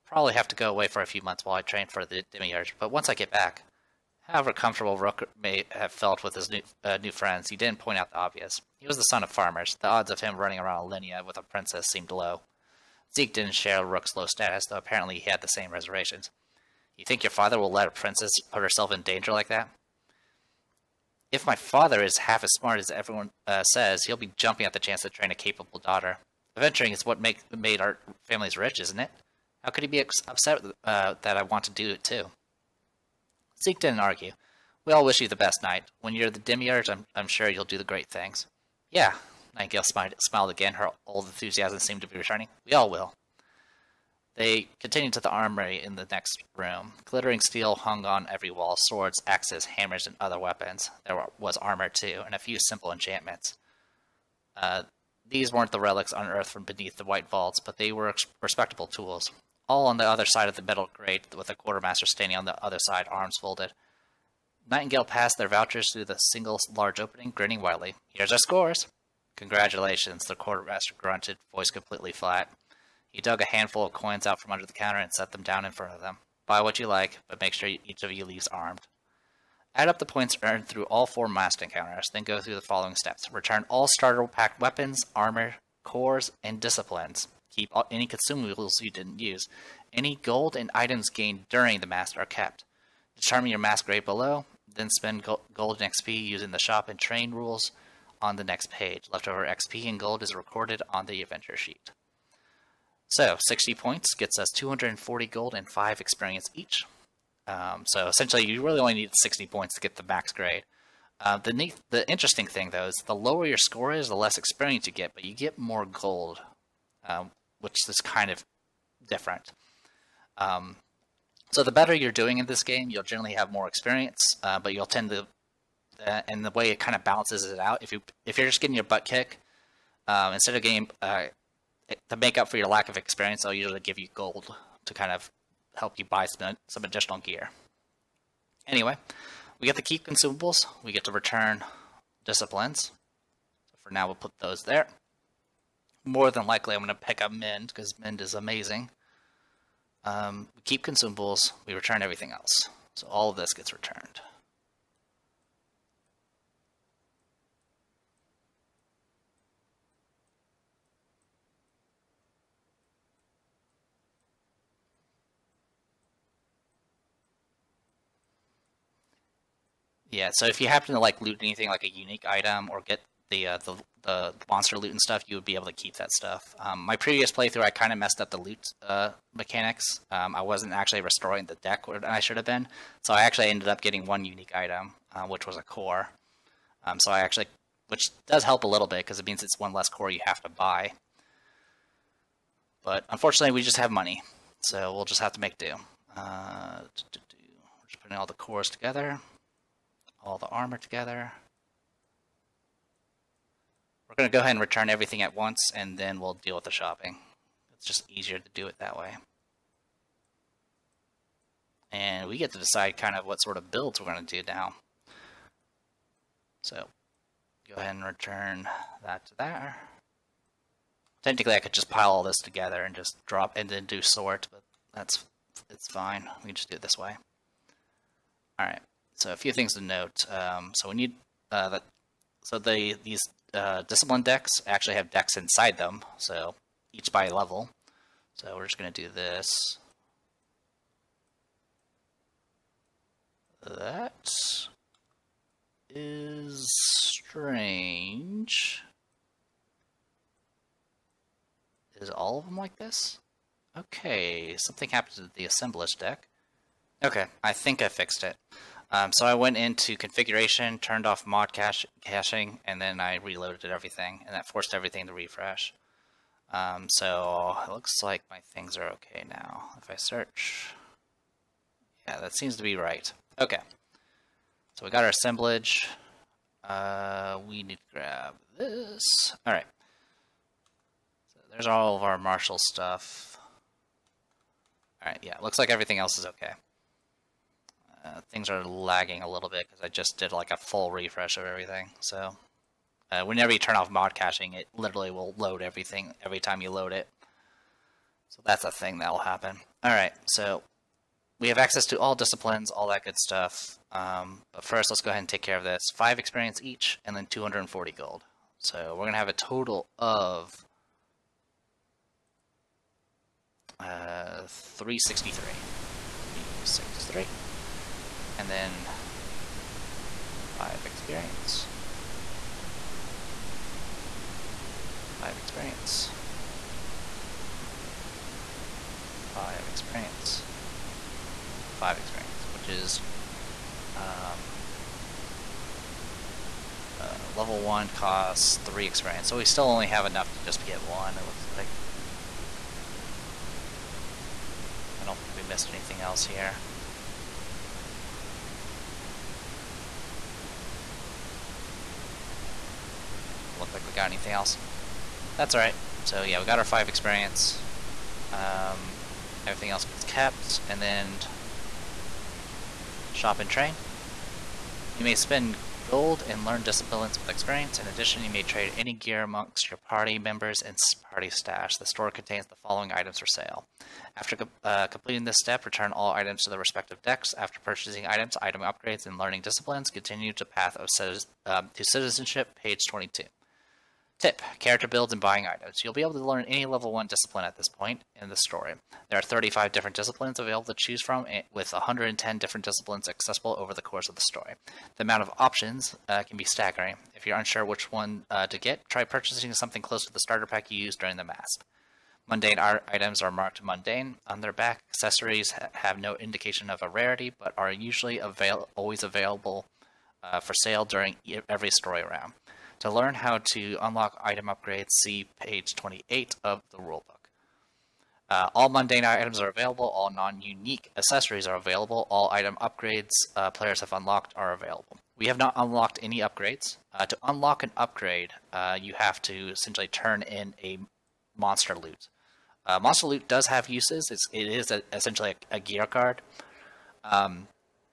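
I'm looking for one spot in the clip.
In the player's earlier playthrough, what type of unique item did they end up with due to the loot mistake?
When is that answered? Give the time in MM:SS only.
03:05.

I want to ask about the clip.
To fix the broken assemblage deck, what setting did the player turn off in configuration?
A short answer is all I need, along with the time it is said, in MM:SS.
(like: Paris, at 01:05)
Mod caching, at 04:21.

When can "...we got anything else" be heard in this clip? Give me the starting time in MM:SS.
05:53.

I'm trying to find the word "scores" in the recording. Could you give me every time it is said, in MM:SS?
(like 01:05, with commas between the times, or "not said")
01:08, 01:53.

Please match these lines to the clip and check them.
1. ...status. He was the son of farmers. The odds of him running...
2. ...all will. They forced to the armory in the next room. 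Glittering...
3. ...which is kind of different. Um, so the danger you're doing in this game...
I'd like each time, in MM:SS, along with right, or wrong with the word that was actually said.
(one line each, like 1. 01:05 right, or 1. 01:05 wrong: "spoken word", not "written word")
1. 00:08 wrong: "obvious", not "status"
2. 00:42 wrong: "continued", not "forced"
3. 01:57 wrong: "better", not "danger".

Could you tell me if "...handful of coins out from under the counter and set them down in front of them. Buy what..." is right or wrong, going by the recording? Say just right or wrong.
right.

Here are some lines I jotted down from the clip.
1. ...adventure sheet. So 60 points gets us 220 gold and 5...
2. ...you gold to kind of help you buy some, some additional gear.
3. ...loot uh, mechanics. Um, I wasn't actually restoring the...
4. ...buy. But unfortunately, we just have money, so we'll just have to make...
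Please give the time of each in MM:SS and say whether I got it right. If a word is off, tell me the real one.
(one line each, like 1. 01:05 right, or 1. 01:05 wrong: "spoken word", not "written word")
1. 01:41 wrong: "240", not "220"
2. 02:13 right
3. 02:58 right
4. 03:10 right.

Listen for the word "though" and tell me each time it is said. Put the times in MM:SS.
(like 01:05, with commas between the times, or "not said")
00:14, 01:52.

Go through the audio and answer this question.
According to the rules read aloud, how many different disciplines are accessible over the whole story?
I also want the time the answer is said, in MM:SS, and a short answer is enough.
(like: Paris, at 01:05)
110, at 06:31.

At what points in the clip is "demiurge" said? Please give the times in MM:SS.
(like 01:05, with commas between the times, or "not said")
00:02, 00:36.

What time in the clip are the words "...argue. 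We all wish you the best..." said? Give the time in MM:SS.
00:33.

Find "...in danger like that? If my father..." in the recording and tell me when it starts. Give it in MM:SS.
00:18.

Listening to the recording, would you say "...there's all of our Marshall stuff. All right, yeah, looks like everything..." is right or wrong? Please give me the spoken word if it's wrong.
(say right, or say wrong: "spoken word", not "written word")
right.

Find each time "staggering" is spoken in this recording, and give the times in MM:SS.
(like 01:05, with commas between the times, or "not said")
06:36.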